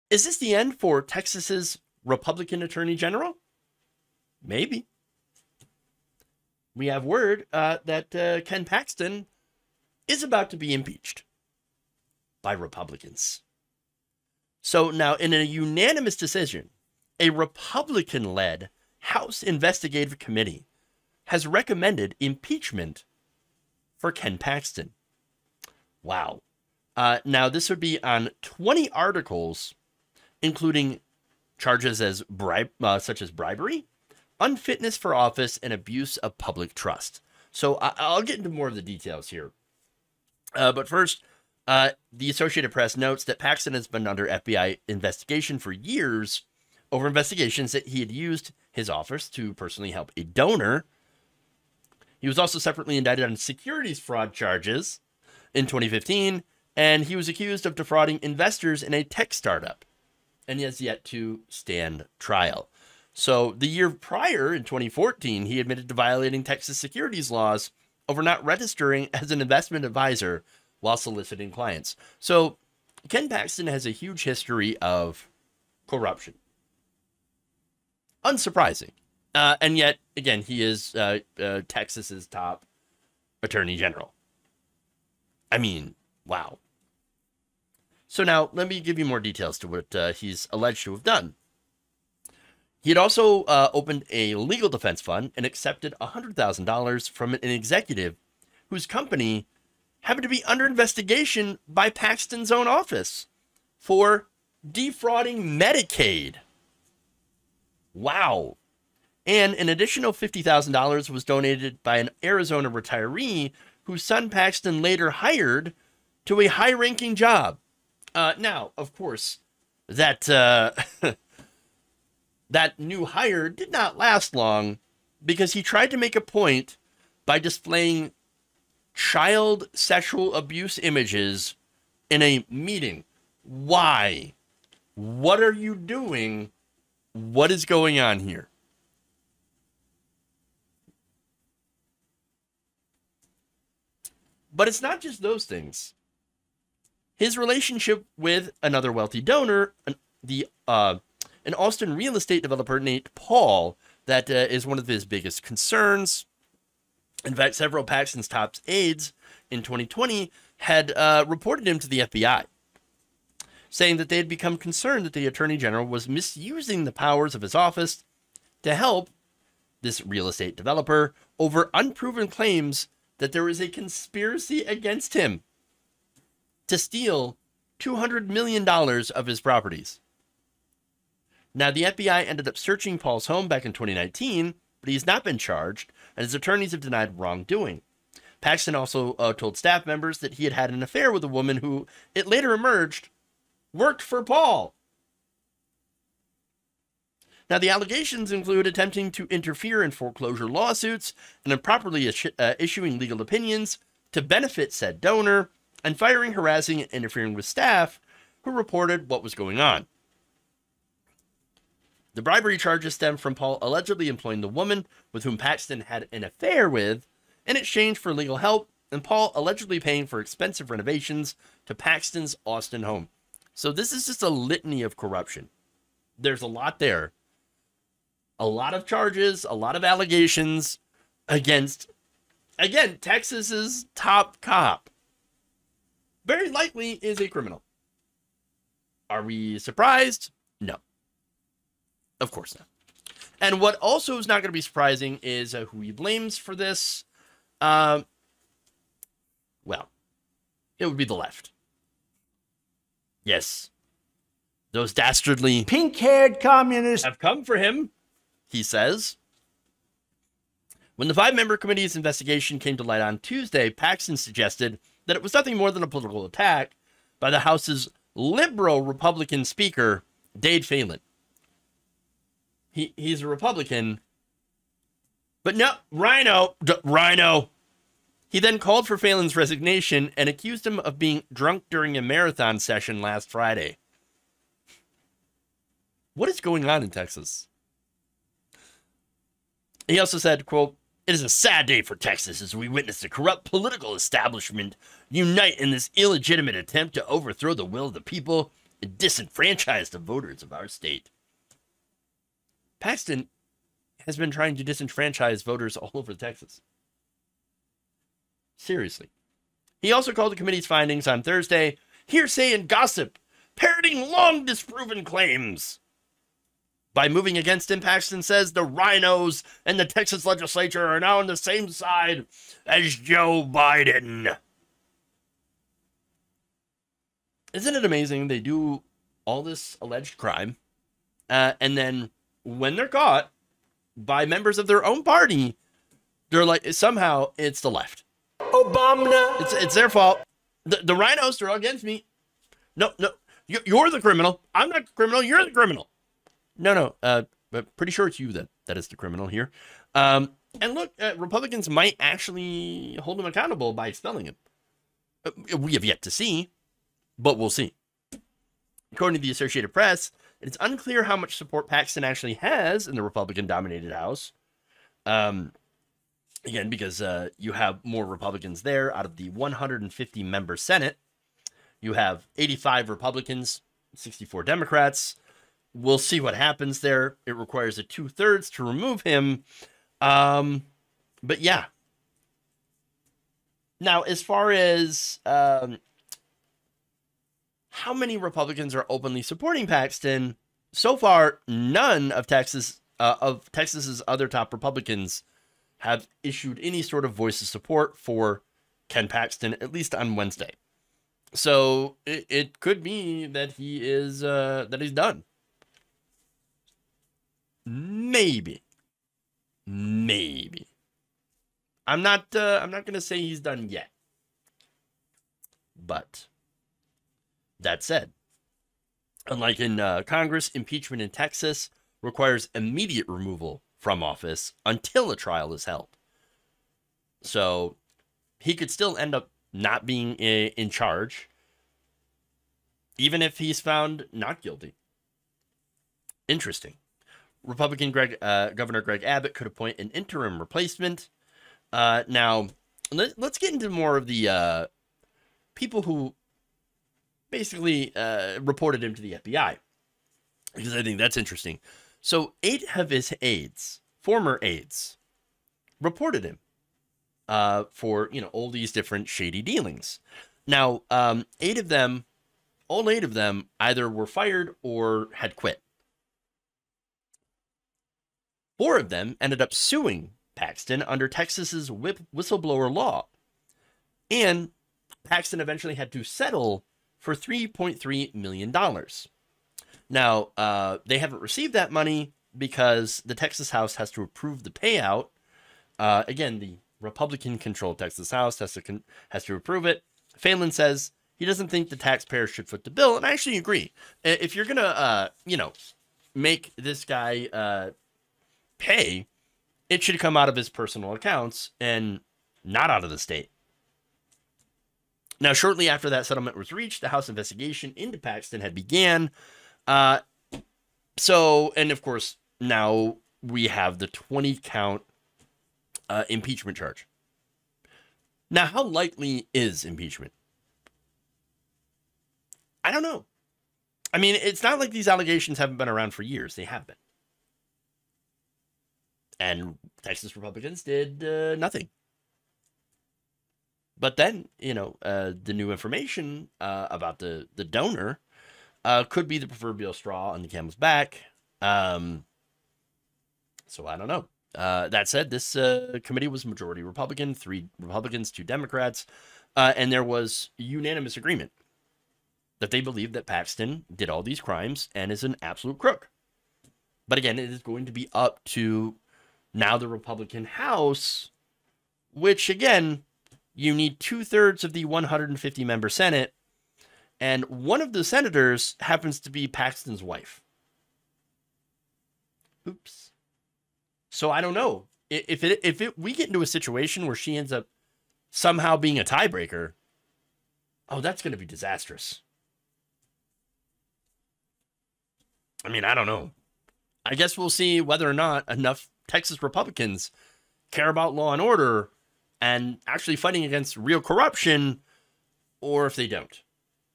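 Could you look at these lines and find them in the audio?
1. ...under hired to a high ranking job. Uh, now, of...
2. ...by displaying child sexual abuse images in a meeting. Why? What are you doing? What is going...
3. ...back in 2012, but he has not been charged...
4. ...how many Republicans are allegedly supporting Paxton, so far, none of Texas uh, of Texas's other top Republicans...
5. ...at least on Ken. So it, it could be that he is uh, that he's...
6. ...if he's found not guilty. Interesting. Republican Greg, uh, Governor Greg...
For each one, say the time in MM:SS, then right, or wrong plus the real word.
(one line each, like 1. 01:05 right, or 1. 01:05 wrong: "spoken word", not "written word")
1. 01:54 wrong: "later", not "under"
2. 02:07 right
3. 03:03 wrong: "2019", not "2012"
4. 06:27 wrong: "openly", not "allegedly"
5. 06:39 wrong: "Wednesday", not "Ken"
6. 07:13 right.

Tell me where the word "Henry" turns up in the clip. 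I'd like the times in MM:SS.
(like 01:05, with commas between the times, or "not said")
not said.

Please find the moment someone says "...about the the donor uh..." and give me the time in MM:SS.
08:56.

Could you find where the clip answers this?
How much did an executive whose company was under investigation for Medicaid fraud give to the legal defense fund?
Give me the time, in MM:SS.
01:36.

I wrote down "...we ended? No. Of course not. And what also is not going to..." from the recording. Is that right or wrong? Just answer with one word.
wrong.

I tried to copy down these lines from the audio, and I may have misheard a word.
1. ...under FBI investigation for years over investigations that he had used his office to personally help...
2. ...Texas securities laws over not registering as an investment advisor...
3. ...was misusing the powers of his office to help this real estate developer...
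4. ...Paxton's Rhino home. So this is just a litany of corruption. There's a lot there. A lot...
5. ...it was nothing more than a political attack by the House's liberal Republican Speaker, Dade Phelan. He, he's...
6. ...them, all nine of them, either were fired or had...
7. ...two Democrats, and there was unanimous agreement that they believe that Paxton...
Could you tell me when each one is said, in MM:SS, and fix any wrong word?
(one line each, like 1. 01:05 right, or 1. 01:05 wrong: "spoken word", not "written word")
1. 00:44 right
2. 01:06 right
3. 02:45 right
4. 03:41 wrong: "Austin", not "Rhino"
5. 04:25 right
6. 07:41 wrong: "eight", not "nine"
7. 09:08 right.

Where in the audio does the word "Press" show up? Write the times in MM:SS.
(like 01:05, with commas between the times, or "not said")
00:42, 05:59.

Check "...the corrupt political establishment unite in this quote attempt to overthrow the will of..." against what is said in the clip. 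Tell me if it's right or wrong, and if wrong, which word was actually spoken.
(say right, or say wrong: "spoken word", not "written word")
wrong: "illegitimate", not "quote".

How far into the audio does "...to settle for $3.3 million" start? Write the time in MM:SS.
07:55.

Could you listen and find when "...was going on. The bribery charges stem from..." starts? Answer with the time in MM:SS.
03:29.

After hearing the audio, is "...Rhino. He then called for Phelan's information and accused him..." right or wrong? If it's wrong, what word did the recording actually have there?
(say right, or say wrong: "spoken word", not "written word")
wrong: "resignation", not "information".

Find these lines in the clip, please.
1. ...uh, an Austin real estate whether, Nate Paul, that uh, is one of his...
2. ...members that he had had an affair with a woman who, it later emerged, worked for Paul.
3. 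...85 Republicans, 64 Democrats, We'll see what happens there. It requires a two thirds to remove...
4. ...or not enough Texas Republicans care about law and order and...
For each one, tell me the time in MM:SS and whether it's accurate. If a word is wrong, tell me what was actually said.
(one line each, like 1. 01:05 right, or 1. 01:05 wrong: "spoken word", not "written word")
1. 02:30 wrong: "developer", not "whether"
2. 03:09 right
3. 06:12 right
4. 09:47 right.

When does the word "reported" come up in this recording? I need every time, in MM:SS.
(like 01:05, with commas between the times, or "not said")
02:41, 03:28, 07:28, 07:35.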